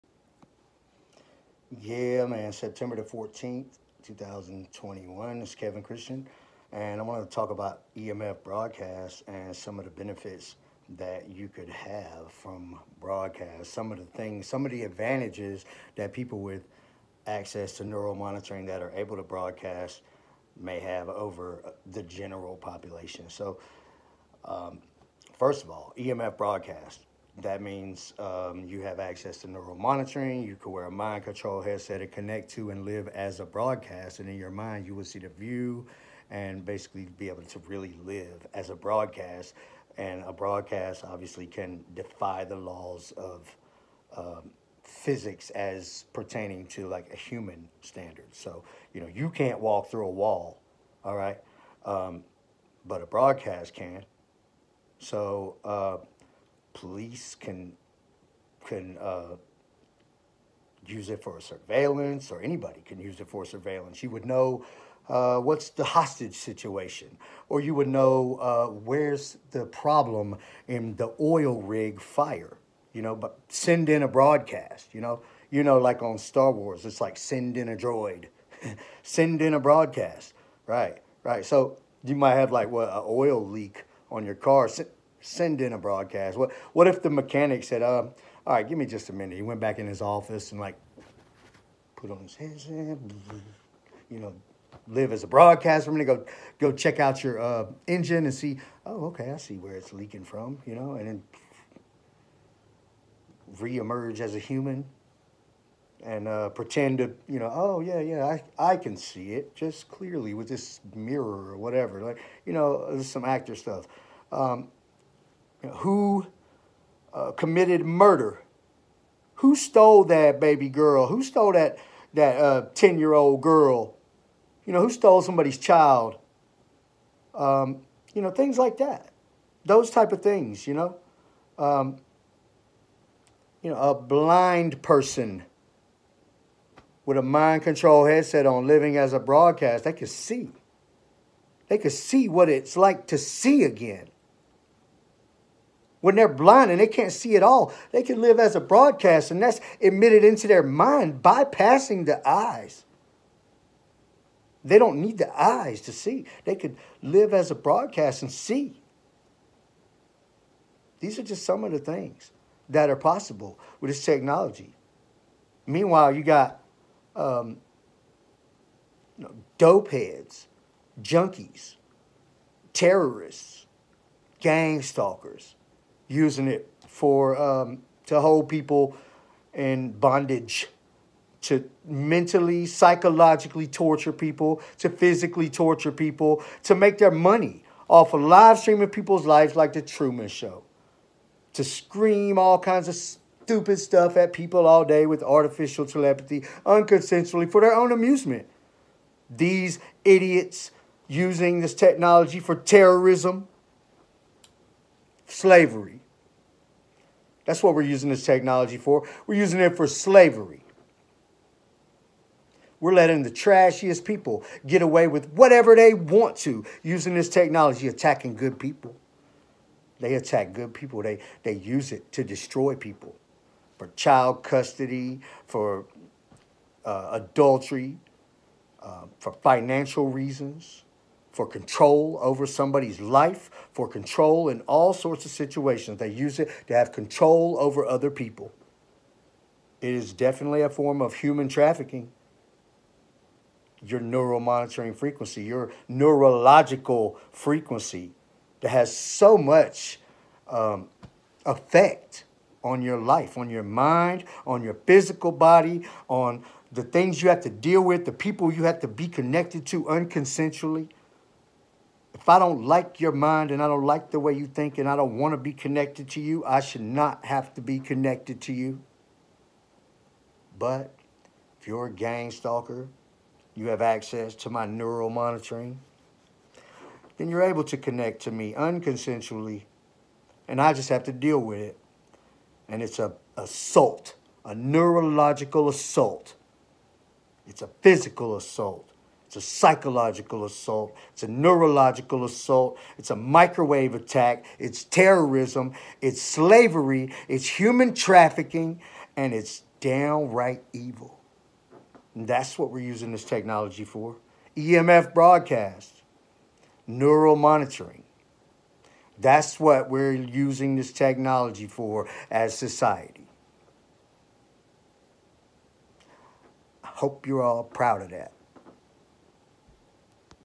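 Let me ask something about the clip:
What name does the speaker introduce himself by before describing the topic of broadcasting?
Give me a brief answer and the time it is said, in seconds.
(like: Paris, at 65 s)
Kevin Christian, at 5 s.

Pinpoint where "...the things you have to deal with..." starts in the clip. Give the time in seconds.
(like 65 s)
256 s.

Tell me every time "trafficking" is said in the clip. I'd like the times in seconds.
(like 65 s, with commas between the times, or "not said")
241 s, 297 s.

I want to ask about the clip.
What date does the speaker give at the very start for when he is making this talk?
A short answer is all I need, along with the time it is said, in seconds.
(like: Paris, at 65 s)
September 14, 2021, at 2 s.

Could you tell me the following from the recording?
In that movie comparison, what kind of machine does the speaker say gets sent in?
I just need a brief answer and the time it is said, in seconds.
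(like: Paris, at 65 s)
droid, at 77 s.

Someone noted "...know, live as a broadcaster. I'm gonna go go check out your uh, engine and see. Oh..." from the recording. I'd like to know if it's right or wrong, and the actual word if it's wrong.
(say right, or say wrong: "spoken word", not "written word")
right.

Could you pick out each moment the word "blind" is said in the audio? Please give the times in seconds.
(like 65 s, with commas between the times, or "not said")
133 s, 146 s.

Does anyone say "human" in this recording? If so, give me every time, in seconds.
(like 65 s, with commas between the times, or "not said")
47 s, 104 s, 241 s, 297 s.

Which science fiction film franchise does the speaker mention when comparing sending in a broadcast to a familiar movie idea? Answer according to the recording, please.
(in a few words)
Star Wars.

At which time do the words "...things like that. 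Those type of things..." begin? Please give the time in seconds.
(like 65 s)
128 s.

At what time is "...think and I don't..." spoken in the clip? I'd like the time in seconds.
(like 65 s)
264 s.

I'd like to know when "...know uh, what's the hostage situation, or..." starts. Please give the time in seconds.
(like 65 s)
64 s.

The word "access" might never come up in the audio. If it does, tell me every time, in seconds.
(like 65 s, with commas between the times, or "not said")
17 s, 28 s, 273 s.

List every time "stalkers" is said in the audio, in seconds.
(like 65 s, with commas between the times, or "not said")
174 s, 272 s.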